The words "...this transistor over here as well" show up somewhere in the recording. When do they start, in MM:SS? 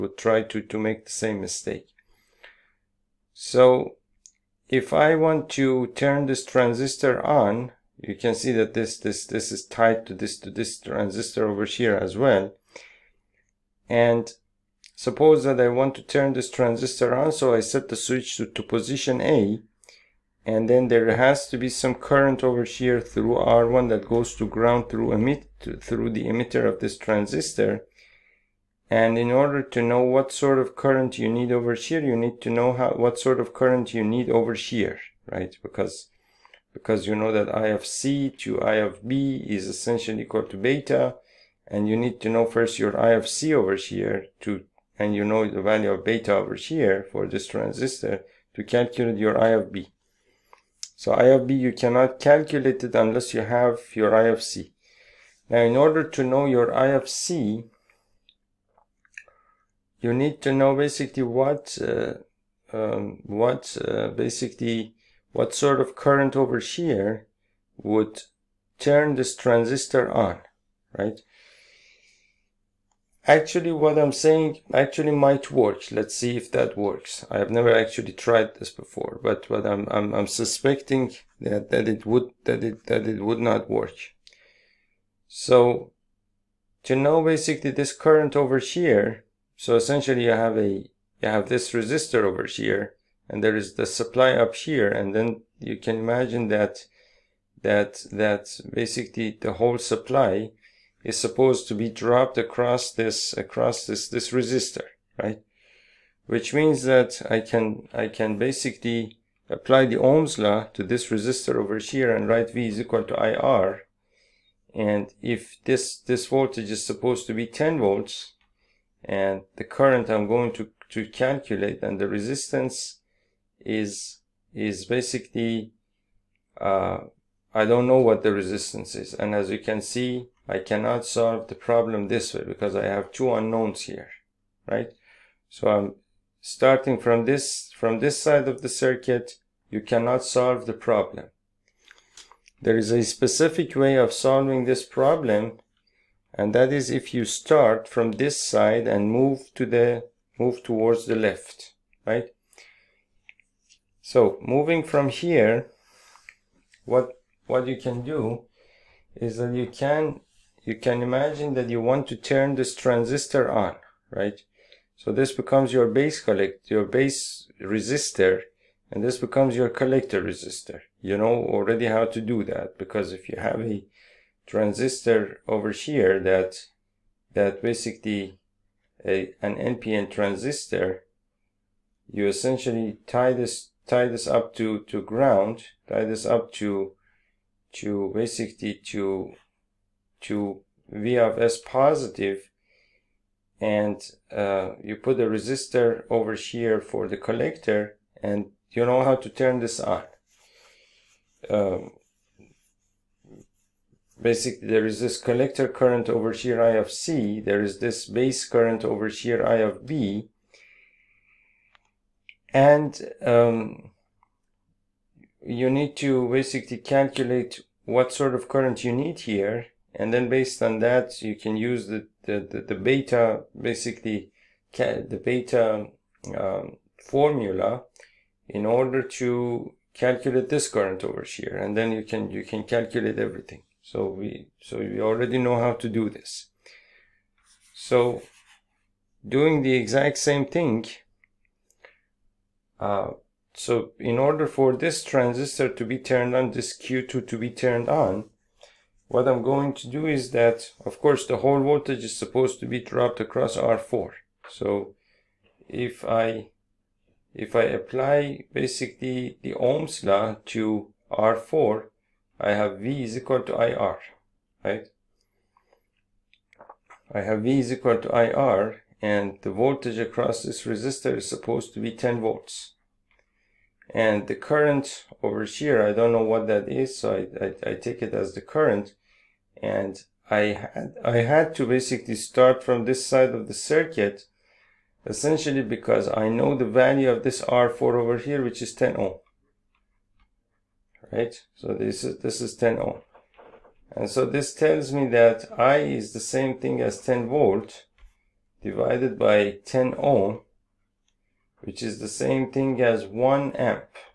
00:10.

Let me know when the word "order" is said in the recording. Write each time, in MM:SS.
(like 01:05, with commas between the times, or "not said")
00:29, 00:55, 03:48, 04:04.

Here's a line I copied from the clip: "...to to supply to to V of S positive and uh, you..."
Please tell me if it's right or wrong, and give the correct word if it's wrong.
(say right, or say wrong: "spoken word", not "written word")
wrong: "basically", not "supply".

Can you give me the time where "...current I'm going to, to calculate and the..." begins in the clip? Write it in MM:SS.
01:59.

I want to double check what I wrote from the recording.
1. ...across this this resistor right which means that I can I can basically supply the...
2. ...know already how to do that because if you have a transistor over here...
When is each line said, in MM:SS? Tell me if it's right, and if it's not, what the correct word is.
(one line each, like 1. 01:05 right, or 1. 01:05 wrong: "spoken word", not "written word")
1. 01:43 wrong: "apply", not "supply"
2. 02:51 right.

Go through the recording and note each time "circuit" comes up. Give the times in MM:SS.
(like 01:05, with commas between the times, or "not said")
02:18, 04:43.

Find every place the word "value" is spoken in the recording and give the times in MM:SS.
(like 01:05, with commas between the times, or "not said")
00:45, 04:46.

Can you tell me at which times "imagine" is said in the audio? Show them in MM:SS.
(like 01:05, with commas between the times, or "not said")
01:35, 02:41.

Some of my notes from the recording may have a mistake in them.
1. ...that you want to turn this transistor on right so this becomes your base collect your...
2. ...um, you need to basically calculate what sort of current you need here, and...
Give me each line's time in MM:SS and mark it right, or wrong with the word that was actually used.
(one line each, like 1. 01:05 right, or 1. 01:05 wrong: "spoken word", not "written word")
1. 02:41 right
2. 03:33 right.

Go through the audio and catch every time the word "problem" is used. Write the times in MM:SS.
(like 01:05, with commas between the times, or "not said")
02:11, 02:20, 02:24.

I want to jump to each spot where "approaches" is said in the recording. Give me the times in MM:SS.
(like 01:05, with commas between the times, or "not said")
not said.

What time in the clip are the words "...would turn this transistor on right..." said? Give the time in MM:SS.
01:07.